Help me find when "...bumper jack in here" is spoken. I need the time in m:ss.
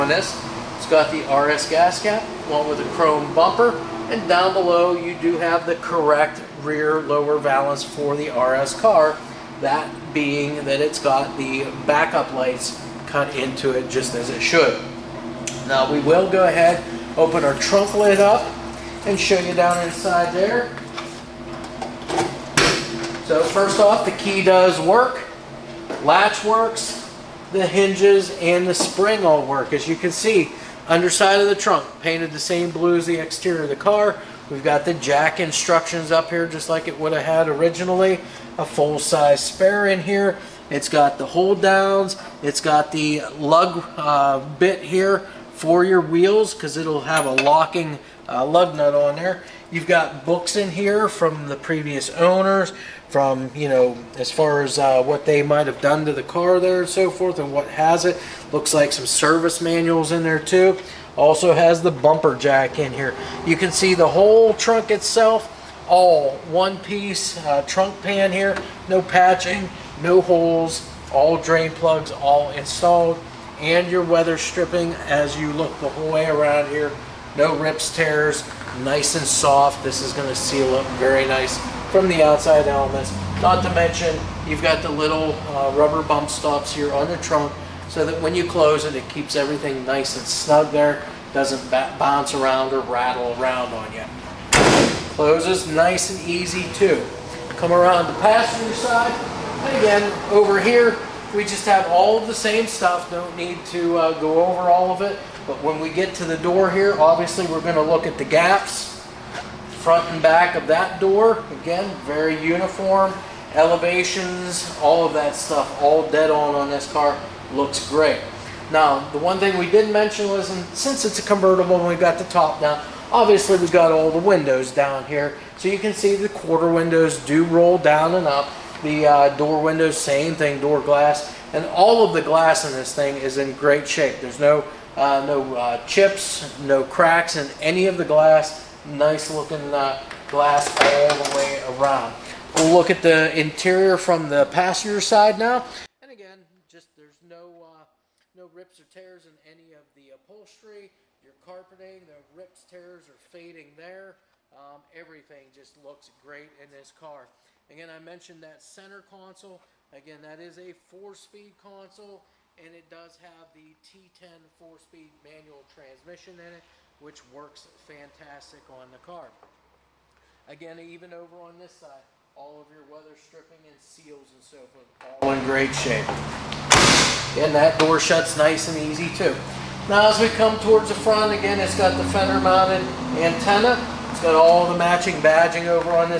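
1:01.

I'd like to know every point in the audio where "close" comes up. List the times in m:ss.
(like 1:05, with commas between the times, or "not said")
1:28, 1:35.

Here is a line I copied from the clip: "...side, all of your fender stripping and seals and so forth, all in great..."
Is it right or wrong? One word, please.
wrong.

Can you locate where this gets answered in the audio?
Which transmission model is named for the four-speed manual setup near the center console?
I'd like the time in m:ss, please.
2:43.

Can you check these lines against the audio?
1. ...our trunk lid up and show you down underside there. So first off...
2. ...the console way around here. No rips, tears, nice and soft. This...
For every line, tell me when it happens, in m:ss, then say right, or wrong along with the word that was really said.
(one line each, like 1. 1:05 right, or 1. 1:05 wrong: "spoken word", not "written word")
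1. 0:17 wrong: "inside", not "underside"
2. 1:15 wrong: "whole", not "console".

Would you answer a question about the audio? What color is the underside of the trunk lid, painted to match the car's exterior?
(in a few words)
Blue.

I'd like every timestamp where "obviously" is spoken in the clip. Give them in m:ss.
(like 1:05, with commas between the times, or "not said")
1:46, 2:03.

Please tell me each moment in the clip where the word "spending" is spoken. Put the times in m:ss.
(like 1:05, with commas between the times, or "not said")
not said.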